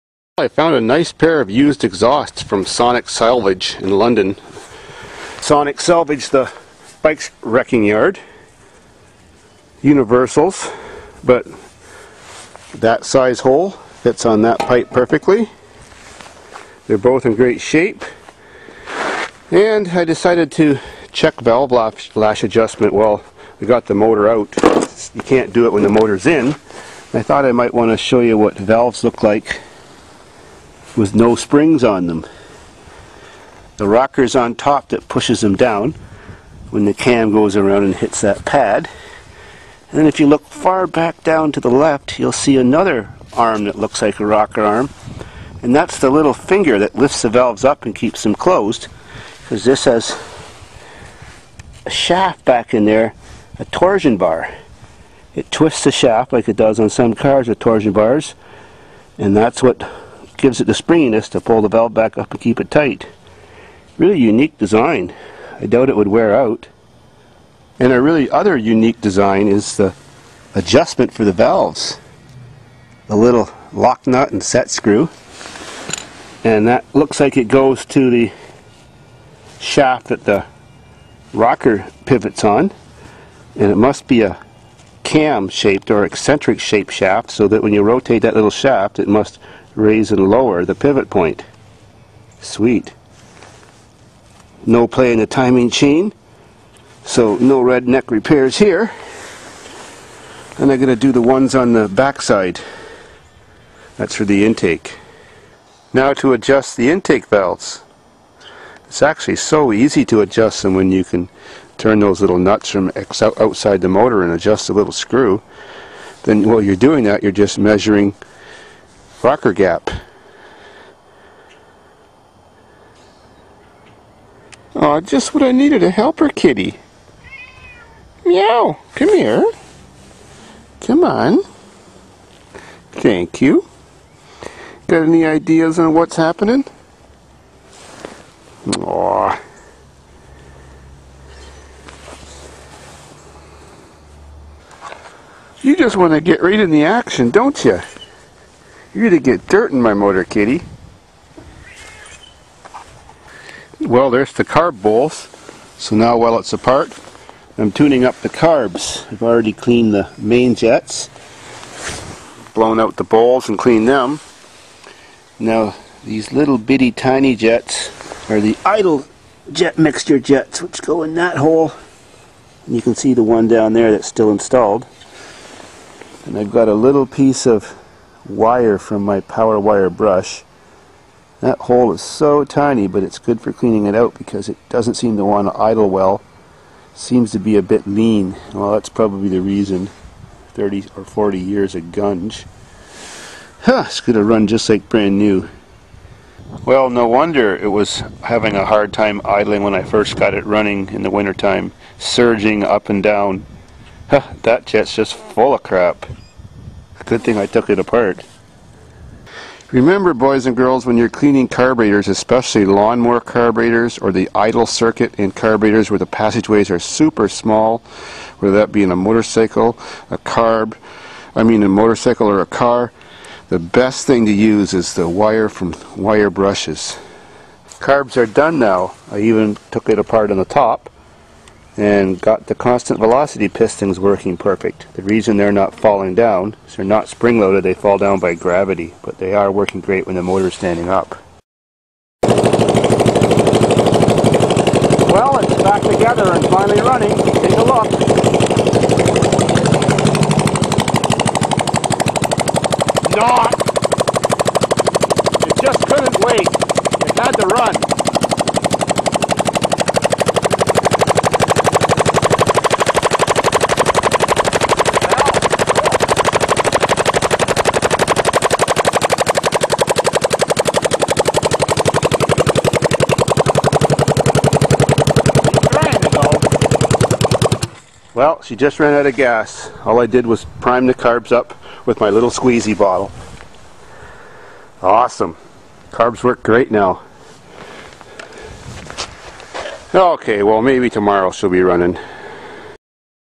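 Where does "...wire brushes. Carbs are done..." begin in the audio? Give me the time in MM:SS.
03:45.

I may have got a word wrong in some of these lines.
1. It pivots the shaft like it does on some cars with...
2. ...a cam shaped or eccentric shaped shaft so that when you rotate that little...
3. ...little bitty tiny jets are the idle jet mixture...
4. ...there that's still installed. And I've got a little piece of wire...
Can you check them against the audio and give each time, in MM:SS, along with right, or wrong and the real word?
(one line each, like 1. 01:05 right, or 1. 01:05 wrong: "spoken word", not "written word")
1. 00:55 wrong: "twists", not "pivots"
2. 01:24 right
3. 02:46 right
4. 02:53 right.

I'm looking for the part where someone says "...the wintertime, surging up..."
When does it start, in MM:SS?
03:21.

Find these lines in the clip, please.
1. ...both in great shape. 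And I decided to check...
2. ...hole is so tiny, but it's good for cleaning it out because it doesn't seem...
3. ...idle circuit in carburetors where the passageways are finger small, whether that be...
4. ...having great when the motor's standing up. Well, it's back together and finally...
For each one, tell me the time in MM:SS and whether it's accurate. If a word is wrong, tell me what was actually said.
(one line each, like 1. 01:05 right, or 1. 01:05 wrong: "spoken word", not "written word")
1. 00:16 right
2. 03:01 right
3. 03:34 wrong: "super", not "finger"
4. 03:59 wrong: "working", not "having".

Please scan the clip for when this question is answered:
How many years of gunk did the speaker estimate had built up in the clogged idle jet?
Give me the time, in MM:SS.
03:10.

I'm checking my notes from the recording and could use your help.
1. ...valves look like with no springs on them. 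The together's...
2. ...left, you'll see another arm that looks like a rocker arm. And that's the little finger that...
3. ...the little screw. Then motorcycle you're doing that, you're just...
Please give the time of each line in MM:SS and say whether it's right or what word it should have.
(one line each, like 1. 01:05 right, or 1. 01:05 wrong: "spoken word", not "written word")
1. 00:28 wrong: "rocker", not "together"
2. 00:41 right
3. 01:54 wrong: "while", not "motorcycle".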